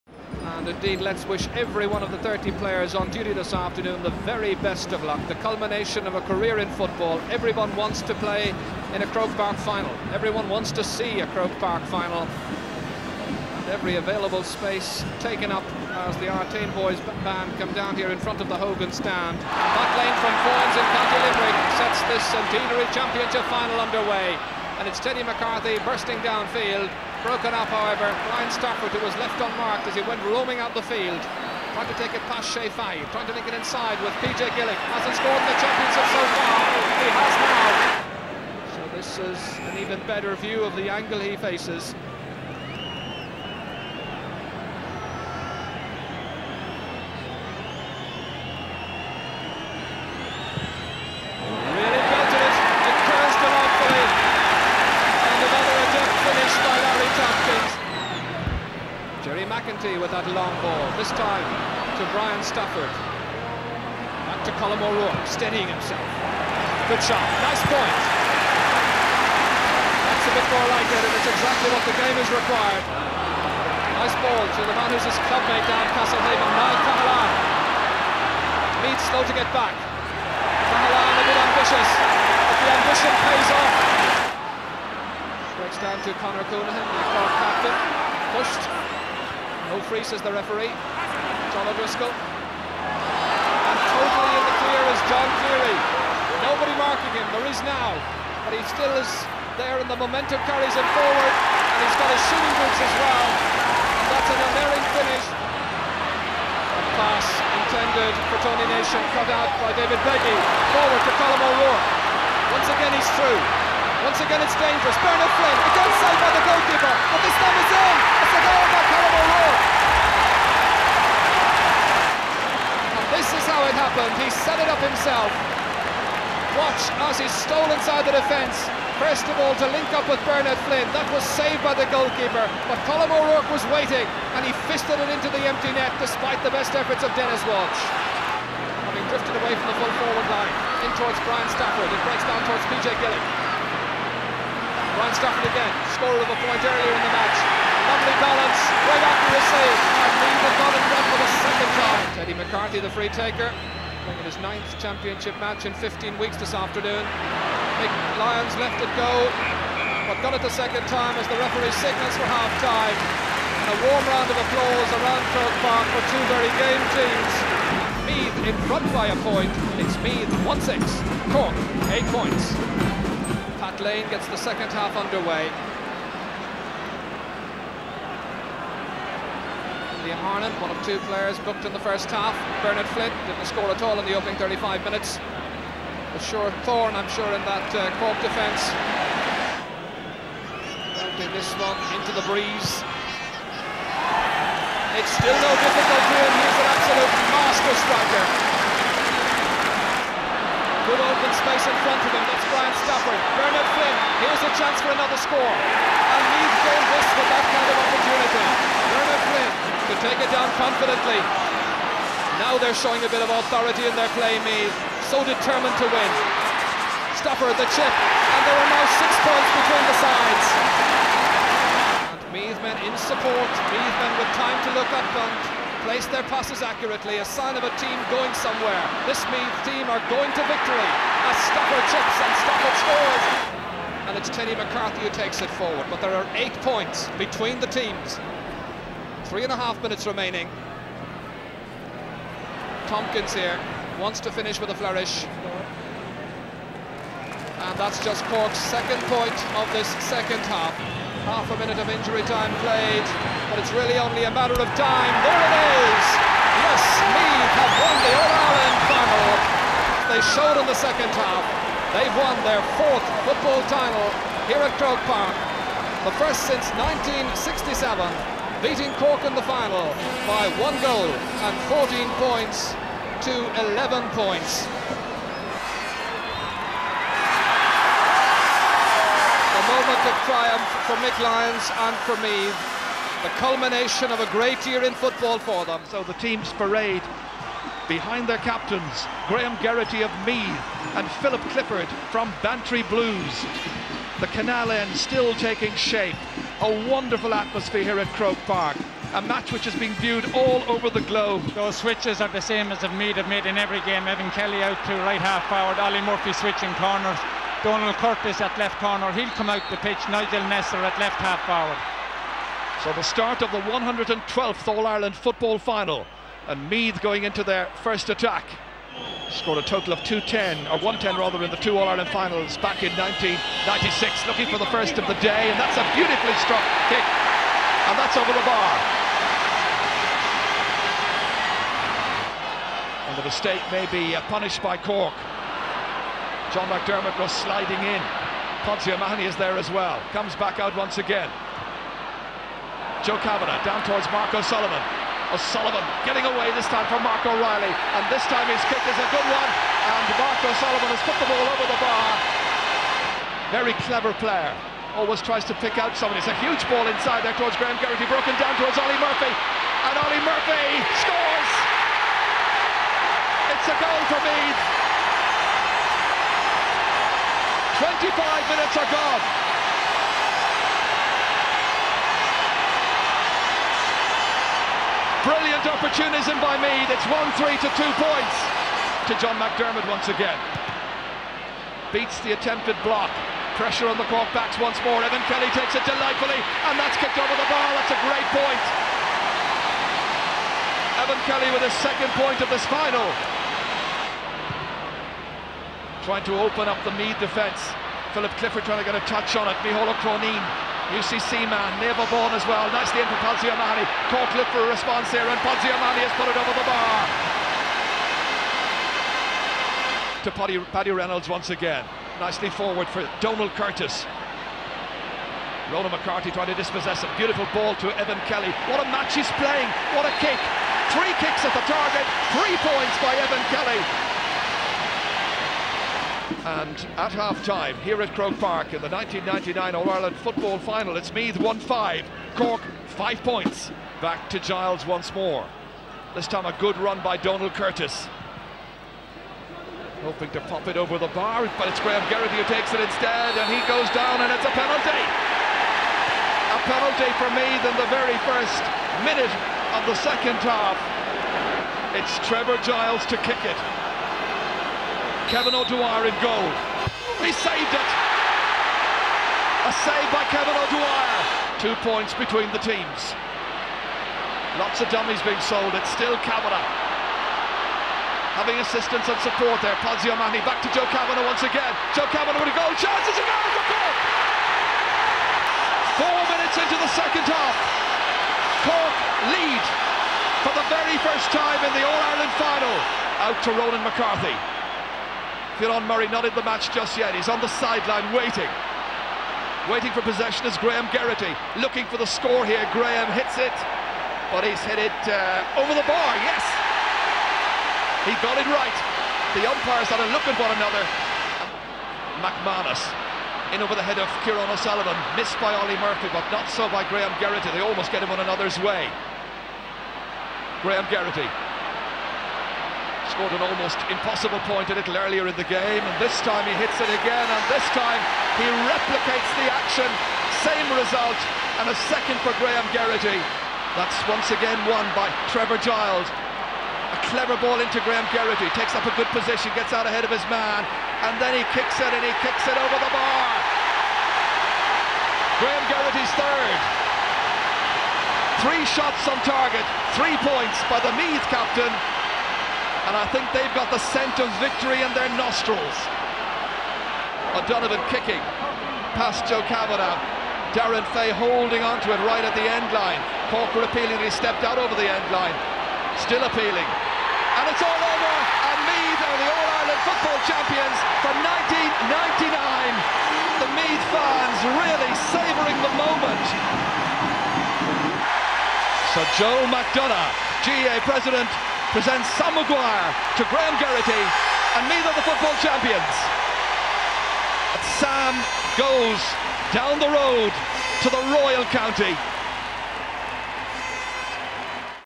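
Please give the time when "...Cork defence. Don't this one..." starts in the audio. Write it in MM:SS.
03:07.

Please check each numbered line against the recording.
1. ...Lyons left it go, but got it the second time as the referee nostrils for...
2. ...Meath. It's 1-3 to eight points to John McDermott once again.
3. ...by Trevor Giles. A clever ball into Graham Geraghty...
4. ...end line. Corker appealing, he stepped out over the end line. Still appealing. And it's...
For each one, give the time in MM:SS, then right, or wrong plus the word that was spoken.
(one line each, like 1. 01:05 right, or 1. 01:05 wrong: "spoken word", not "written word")
1. 02:38 wrong: "signals", not "nostrils"
2. 06:16 wrong: "two", not "eight"
3. 08:44 right
4. 09:12 right.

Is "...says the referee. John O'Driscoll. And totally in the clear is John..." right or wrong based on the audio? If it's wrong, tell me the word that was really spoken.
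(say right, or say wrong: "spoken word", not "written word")
right.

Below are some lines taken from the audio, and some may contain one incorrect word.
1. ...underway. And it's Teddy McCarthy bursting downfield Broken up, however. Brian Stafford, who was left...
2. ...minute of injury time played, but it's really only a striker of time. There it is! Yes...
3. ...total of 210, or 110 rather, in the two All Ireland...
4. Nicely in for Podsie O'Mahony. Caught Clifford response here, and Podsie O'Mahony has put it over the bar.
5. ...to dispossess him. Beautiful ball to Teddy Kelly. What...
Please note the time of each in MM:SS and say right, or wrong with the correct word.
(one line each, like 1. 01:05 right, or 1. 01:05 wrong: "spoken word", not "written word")
1. 00:23 right
2. 04:11 wrong: "matter", not "striker"
3. 05:19 right
4. 06:42 right
5. 06:56 wrong: "Evan", not "Teddy".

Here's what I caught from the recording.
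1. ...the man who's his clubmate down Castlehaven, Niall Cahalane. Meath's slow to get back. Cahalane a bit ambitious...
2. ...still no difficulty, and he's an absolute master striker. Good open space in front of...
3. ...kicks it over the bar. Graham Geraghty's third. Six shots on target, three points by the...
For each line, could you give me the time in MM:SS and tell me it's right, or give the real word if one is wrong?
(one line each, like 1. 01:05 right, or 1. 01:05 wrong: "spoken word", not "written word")
1. 01:14 right
2. 03:15 right
3. 08:52 wrong: "Three", not "Six".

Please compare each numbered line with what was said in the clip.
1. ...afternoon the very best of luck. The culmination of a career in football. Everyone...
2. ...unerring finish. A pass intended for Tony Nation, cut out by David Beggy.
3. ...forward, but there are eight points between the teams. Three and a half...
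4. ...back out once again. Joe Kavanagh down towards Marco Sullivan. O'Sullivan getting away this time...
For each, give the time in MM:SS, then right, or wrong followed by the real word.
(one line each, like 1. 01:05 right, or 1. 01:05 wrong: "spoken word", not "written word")
1. 00:03 right
2. 01:44 right
3. 03:55 right
4. 05:40 right.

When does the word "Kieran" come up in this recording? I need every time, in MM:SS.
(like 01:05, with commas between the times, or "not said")
08:05, 08:24.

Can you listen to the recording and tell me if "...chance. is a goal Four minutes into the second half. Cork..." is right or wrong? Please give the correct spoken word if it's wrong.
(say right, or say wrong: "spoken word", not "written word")
right.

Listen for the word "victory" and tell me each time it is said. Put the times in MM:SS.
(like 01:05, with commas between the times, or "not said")
03:50, 09:04.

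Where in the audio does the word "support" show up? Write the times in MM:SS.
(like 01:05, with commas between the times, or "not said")
03:42, 07:49.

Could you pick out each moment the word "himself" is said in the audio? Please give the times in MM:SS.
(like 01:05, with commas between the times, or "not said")
01:05, 02:04.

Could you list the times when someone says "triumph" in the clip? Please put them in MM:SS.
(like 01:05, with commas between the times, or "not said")
04:40.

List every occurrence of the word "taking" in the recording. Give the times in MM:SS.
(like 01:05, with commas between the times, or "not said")
04:55.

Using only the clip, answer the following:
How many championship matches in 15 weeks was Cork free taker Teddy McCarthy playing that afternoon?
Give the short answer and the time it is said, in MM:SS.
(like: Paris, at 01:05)
9, at 02:34.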